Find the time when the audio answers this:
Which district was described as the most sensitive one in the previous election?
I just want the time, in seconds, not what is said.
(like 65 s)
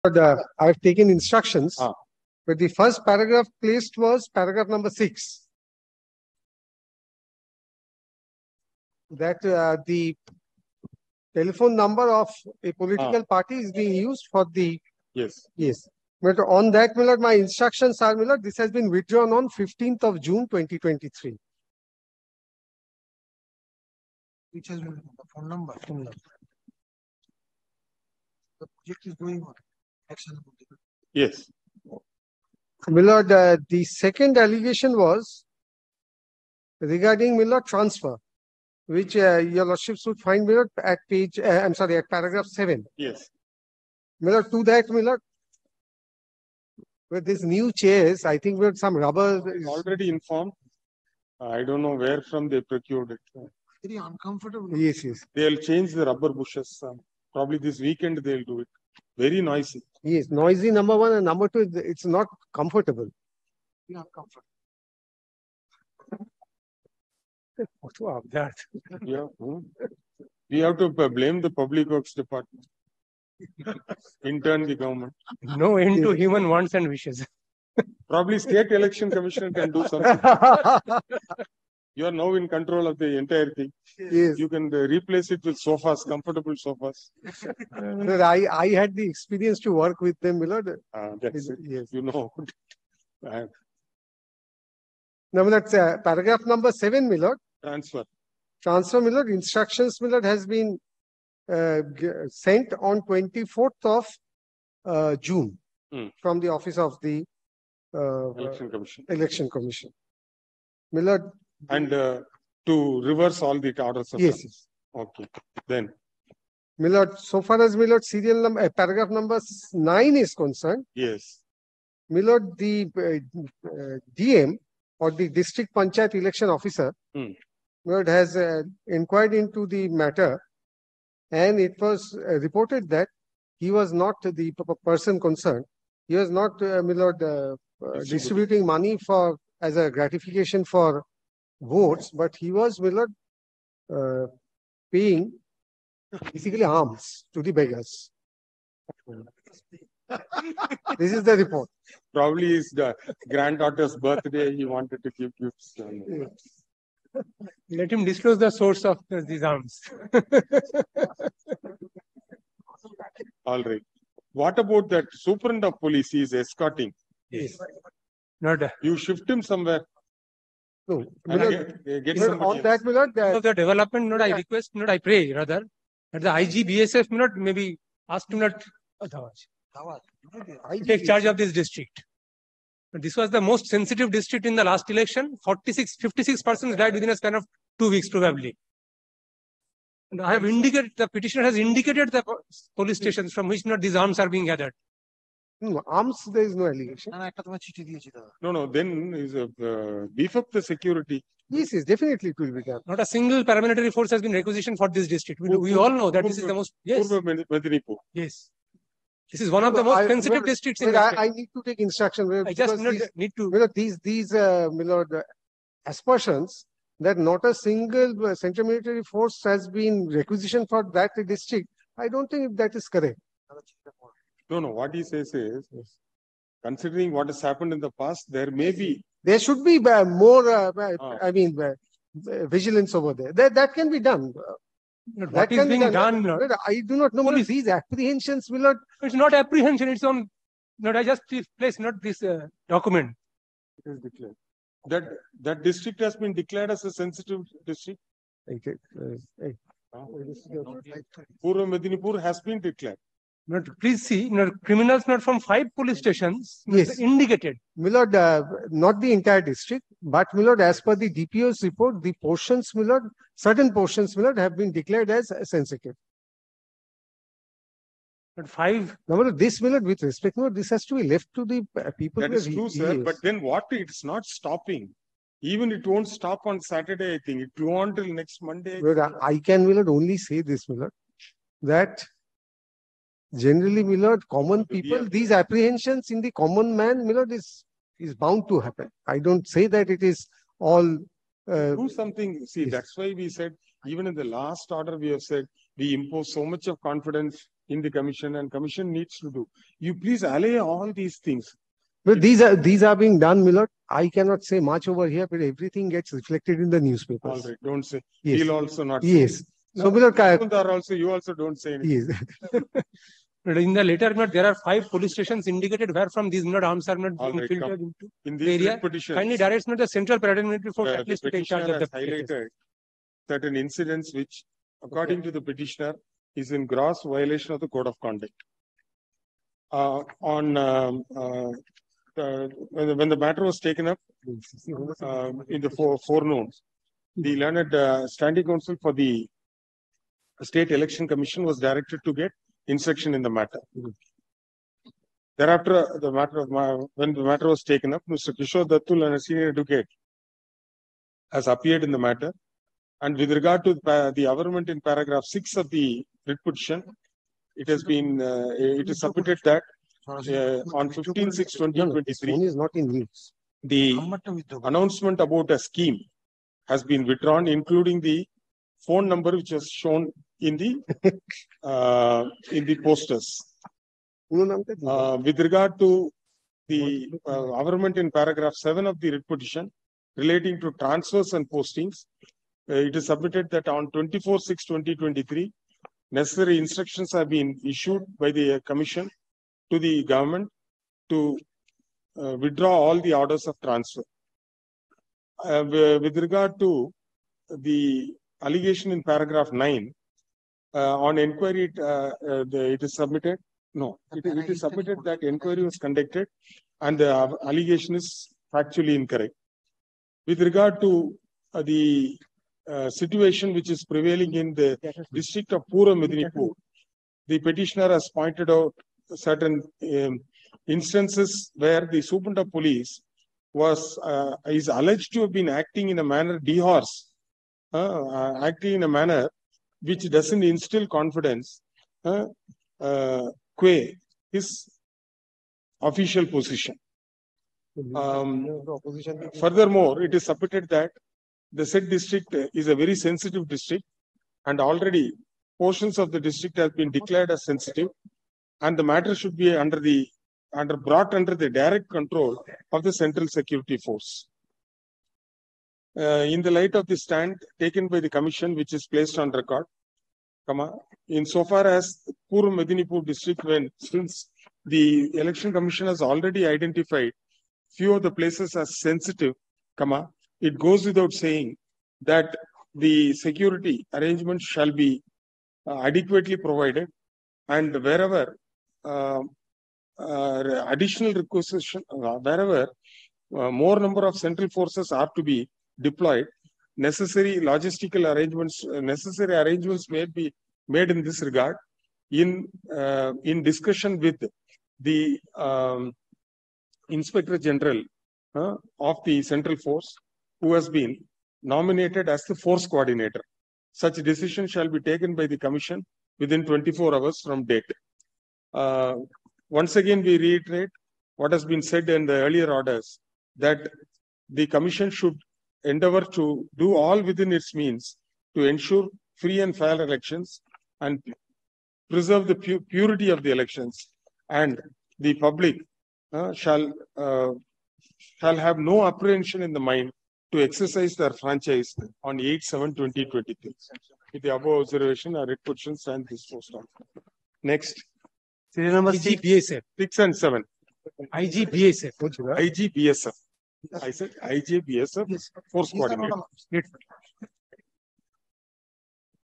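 251 s.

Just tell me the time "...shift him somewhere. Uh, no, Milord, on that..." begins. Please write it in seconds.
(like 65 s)
168 s.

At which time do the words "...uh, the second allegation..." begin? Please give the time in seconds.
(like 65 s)
33 s.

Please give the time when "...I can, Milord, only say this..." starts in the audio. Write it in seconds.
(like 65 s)
279 s.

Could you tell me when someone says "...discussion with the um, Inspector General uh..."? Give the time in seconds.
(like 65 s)
493 s.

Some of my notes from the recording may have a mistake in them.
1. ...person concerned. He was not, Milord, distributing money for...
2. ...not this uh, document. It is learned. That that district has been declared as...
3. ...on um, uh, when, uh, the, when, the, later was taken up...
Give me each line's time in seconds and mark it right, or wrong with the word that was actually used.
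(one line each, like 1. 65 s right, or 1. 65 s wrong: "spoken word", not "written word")
1. 134 s right
2. 241 s wrong: "declared", not "learned"
3. 330 s wrong: "matter", not "later".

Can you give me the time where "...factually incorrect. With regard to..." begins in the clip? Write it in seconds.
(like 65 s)
408 s.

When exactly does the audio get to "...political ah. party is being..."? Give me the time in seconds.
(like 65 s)
12 s.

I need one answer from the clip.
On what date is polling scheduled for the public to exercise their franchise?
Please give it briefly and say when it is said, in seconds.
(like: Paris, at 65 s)
8 July 2023, at 532 s.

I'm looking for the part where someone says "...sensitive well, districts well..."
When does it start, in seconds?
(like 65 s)
210 s.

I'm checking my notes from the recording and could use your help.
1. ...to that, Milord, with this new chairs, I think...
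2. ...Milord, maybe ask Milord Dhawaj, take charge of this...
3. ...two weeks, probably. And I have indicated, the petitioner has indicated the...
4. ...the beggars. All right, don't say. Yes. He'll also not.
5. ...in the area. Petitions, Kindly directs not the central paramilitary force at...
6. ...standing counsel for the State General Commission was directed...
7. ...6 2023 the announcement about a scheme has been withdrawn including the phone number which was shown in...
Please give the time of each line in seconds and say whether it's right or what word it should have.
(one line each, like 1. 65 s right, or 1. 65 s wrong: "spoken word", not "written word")
1. 44 s right
2. 177 s right
3. 187 s right
4. 306 s wrong: "newspapers", not "beggars"
5. 318 s right
6. 338 s wrong: "Election", not "General"
7. 361 s right.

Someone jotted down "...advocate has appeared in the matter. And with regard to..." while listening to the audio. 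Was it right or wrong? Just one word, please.
right.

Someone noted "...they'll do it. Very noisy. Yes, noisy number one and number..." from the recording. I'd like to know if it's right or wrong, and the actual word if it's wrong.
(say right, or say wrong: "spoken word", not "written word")
right.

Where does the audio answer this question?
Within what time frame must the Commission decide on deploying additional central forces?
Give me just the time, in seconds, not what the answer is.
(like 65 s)
506 s.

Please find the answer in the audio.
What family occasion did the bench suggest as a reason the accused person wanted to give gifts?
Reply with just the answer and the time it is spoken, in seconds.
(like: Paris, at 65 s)
Granddaughter's birthday, at 153 s.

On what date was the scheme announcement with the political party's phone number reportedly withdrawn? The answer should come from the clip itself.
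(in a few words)
15th of June 2023.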